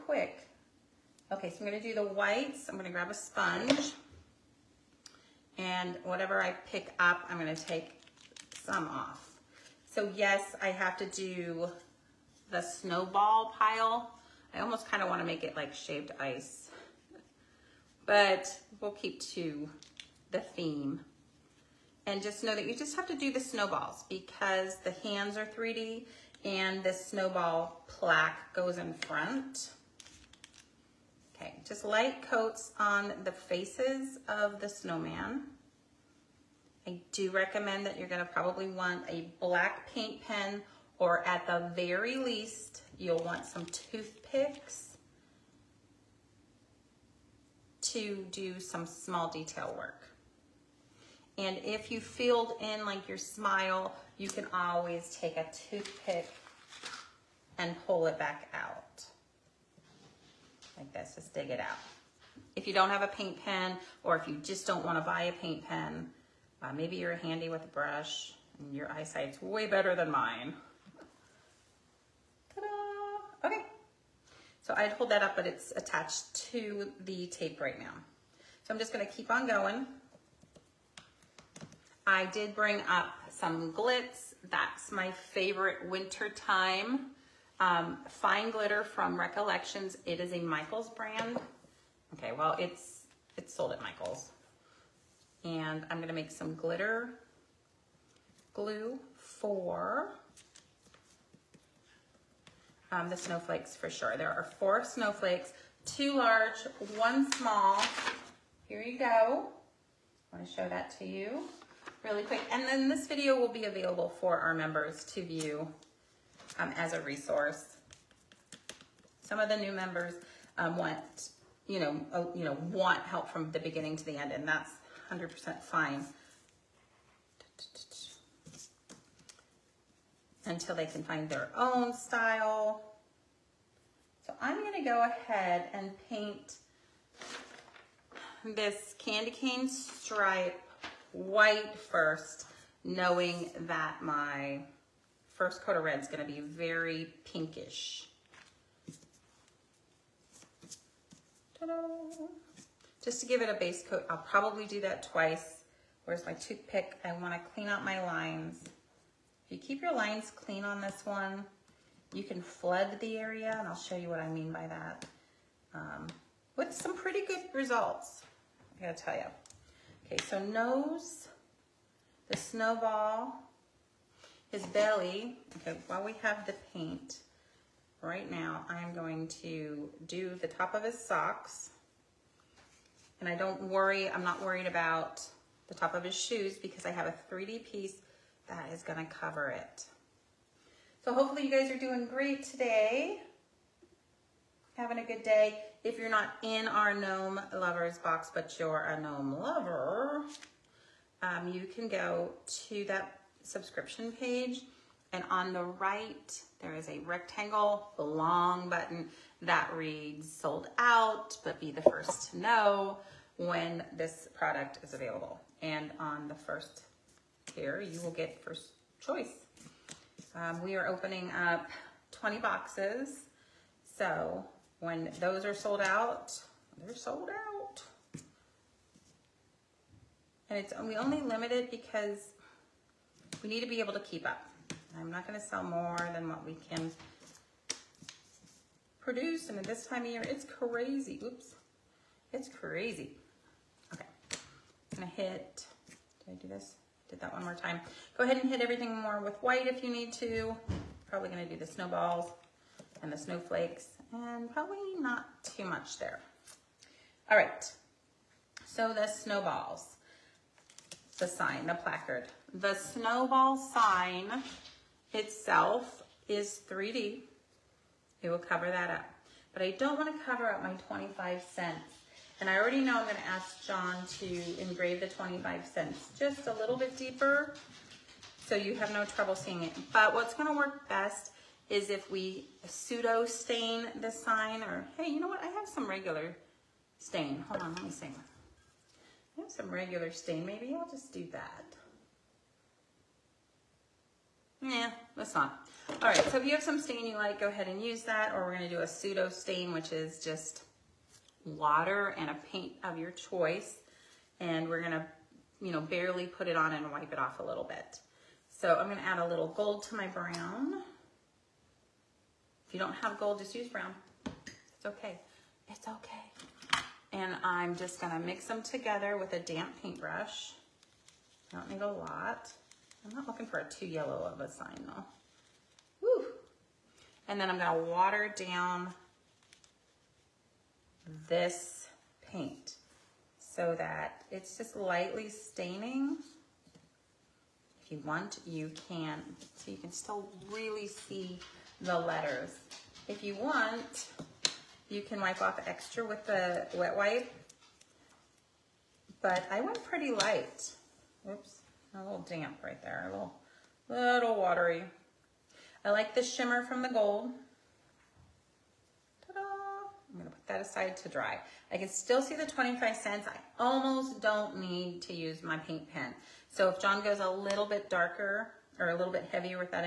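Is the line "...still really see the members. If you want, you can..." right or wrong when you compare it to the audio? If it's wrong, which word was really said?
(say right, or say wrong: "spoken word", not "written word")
wrong: "letters", not "members".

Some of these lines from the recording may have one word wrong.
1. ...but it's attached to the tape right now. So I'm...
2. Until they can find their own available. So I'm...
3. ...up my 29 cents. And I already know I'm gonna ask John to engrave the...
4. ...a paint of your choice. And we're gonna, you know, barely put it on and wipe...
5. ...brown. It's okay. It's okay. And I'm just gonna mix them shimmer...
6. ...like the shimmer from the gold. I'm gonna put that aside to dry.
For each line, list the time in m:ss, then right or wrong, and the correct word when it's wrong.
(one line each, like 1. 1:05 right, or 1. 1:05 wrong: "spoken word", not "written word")
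1. 1:15 right
2. 2:10 wrong: "style", not "available"
3. 4:30 wrong: "25", not "29"
4. 5:02 right
5. 5:13 wrong: "together", not "shimmer"
6. 5:55 right.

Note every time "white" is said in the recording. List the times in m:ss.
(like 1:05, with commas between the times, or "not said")
0:02, 2:21, 4:09.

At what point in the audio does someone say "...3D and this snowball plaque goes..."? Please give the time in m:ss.
0:25.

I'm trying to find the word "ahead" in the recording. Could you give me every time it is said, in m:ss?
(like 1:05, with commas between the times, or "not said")
2:15, 4:08, 4:57.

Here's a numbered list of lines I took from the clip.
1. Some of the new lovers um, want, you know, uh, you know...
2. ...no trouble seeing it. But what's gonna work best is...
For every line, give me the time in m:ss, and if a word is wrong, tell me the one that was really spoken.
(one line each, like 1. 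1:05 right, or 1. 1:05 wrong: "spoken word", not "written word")
1. 1:59 wrong: "members", not "lovers"
2. 4:38 right.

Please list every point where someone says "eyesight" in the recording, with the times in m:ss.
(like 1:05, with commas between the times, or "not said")
1:08.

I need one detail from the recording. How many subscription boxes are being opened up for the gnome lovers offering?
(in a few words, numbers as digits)
20.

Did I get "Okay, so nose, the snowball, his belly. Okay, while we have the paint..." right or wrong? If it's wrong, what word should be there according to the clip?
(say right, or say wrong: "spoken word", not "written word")
right.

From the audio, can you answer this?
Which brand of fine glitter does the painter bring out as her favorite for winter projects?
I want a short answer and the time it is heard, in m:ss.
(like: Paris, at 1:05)
Recollections, at 1:29.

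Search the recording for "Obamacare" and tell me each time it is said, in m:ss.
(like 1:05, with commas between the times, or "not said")
not said.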